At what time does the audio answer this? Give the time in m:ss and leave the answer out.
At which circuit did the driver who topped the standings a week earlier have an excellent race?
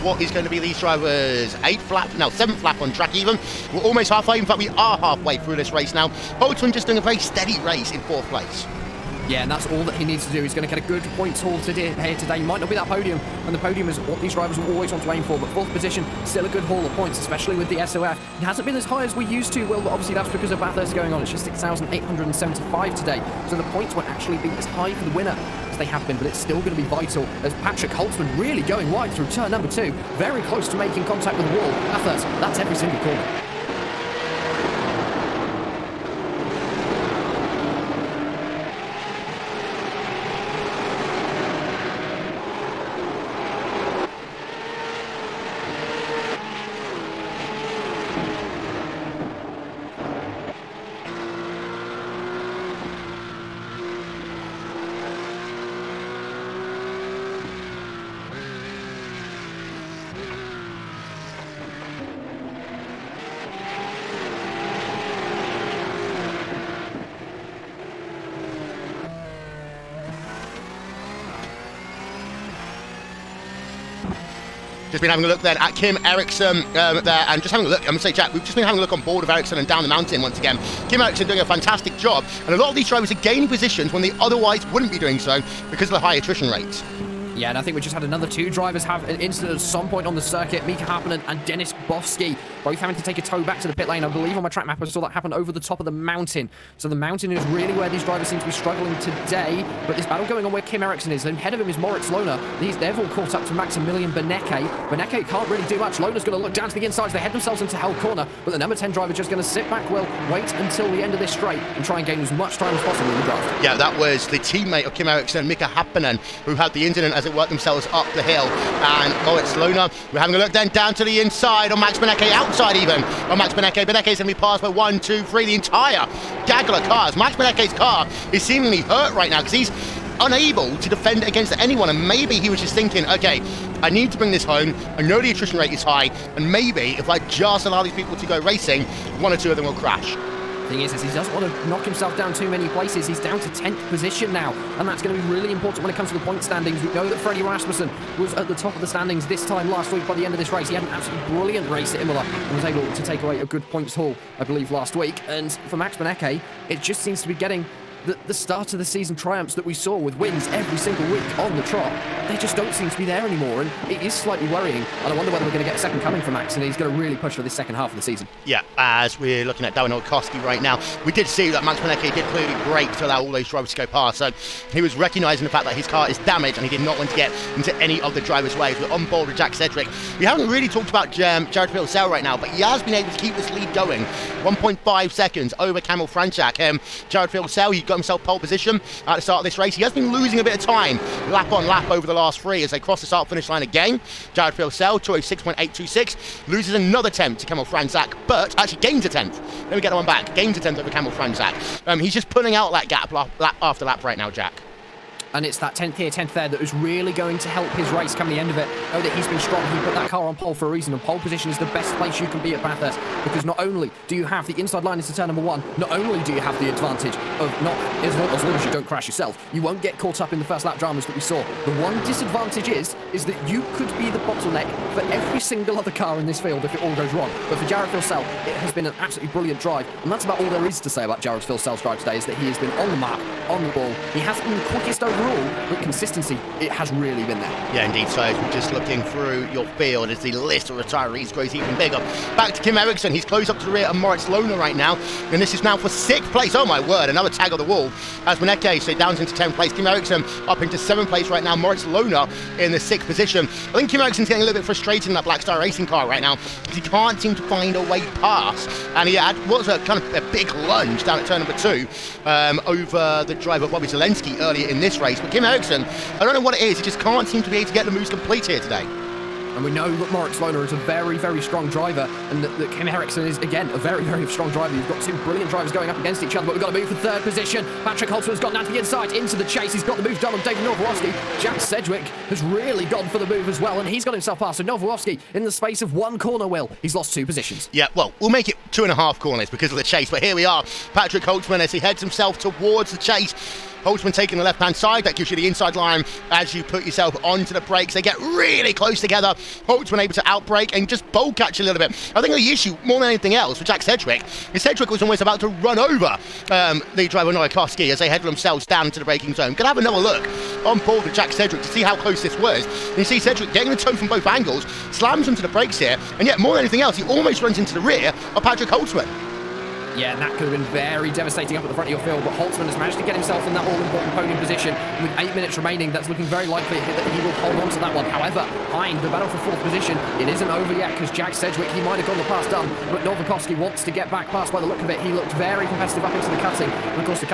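2:31.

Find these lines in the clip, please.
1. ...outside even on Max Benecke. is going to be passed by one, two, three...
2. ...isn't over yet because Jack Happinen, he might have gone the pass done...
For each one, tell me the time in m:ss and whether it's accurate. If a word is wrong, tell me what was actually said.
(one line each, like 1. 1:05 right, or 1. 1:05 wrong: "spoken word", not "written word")
1. 2:02 right
2. 5:30 wrong: "Sedgwick", not "Happinen".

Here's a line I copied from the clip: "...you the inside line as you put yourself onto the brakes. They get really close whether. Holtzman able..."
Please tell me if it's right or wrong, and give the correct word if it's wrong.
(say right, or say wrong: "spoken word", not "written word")
wrong: "together", not "whether".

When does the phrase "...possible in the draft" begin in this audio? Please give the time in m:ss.
1:52.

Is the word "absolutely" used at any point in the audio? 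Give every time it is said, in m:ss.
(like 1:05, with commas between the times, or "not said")
2:30, 3:48.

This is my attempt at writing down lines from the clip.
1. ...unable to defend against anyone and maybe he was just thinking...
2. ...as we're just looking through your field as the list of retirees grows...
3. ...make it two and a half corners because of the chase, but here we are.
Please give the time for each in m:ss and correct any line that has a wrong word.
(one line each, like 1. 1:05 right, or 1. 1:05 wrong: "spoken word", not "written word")
1. 2:10 right
2. 3:58 right
3. 4:48 right.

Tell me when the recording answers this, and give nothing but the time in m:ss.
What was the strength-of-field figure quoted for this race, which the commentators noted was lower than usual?
0:21.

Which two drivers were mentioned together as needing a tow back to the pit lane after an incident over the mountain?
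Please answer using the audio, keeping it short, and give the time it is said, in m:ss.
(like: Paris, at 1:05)
Mika Happinen and Dennis Bofsky, at 1:30.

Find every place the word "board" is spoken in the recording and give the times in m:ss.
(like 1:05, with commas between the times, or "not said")
1:19, 2:59, 5:10.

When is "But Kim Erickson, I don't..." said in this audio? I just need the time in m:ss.
4:25.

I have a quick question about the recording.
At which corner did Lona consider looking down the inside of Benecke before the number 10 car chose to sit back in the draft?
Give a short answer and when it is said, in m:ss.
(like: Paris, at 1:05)
Hell Corner, at 1:47.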